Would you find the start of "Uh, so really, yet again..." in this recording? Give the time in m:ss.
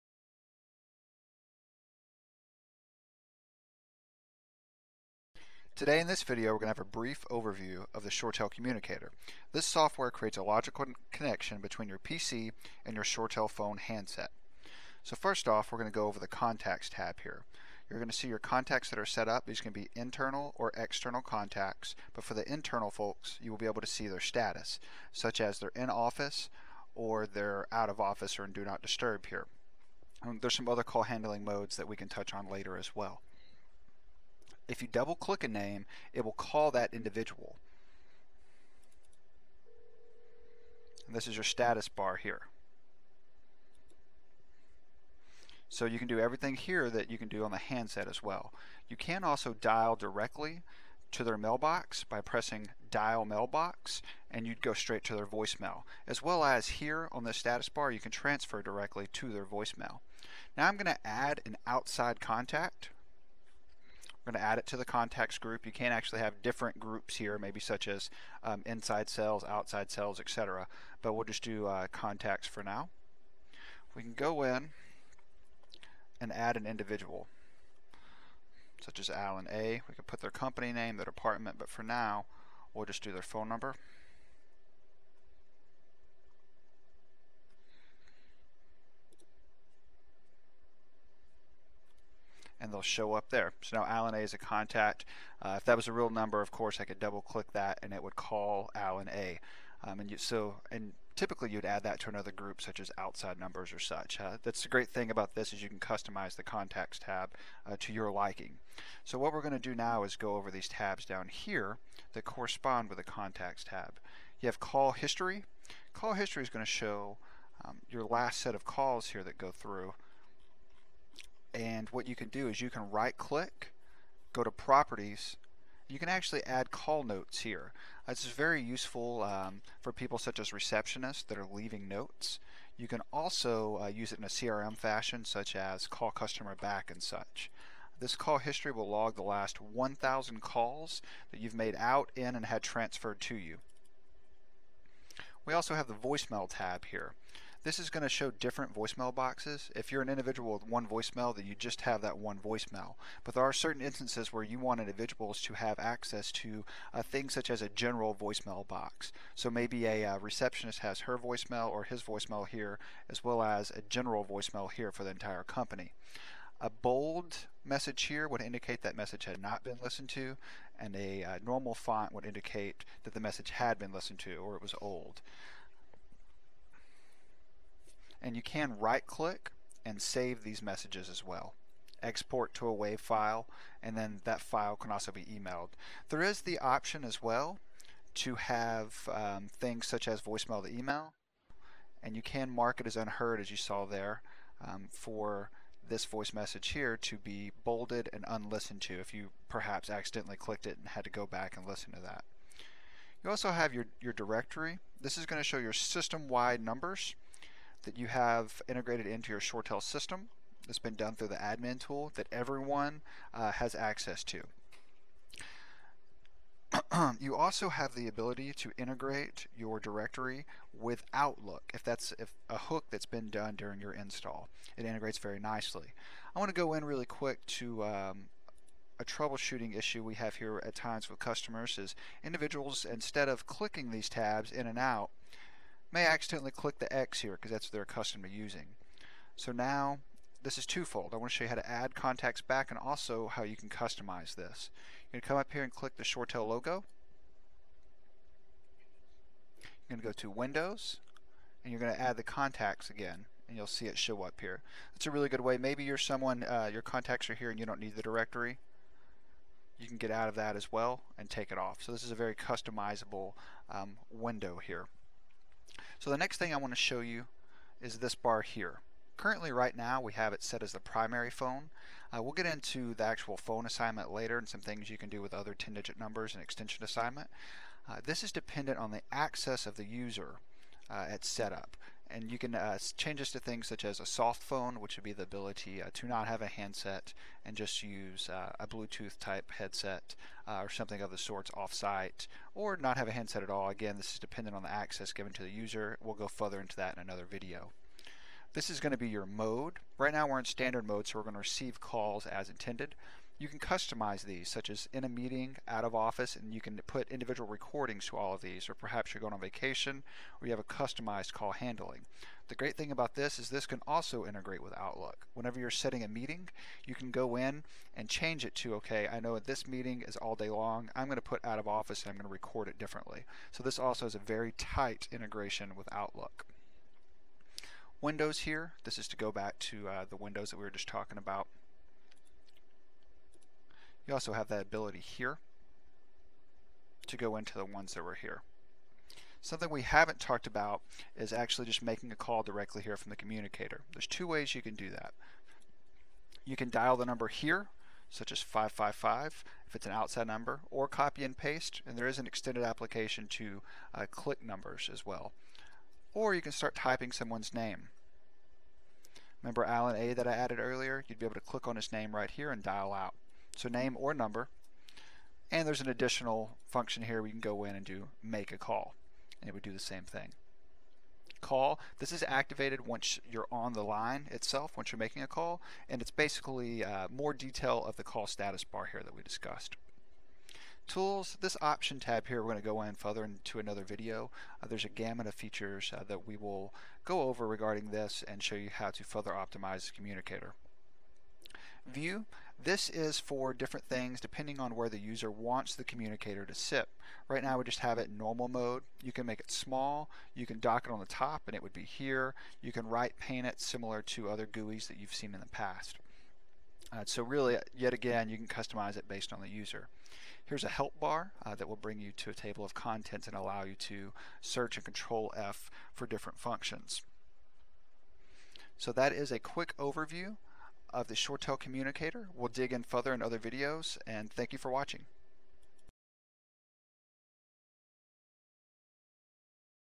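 6:46.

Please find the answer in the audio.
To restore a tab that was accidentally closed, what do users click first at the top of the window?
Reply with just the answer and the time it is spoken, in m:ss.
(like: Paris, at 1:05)
ShoreTel logo, at 4:06.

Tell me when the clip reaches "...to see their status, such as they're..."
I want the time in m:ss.
0:23.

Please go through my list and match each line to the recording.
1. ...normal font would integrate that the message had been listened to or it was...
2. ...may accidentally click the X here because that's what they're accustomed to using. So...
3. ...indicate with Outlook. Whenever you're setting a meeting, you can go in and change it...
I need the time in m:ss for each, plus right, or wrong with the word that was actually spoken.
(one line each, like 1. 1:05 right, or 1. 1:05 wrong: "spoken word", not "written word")
1. 2:51 wrong: "indicate", not "integrate"
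2. 3:55 right
3. 5:14 wrong: "integrate", not "indicate".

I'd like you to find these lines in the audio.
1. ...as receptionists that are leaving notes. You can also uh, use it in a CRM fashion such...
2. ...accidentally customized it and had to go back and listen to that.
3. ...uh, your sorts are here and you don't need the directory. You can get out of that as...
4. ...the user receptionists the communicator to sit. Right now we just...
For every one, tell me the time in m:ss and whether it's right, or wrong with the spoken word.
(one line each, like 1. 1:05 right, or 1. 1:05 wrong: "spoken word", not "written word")
1. 2:10 right
2. 3:19 wrong: "clicked", not "customized"
3. 4:16 wrong: "contacts", not "sorts"
4. 6:34 wrong: "wants", not "receptionists".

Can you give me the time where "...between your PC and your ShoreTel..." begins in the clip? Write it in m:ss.
0:11.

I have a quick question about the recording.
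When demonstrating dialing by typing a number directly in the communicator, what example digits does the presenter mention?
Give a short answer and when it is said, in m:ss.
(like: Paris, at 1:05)
555, at 5:48.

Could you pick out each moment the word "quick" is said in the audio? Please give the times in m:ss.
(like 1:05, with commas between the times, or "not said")
3:47, 6:59.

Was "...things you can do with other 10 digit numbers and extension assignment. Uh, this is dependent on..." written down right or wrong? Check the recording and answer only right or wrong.
right.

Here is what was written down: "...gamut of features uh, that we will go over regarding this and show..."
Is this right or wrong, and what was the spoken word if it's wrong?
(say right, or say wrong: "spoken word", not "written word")
right.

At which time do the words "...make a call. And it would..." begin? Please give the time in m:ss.
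6:08.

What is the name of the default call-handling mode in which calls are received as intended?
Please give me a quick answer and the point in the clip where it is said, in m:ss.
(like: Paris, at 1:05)
standard mode, at 5:00.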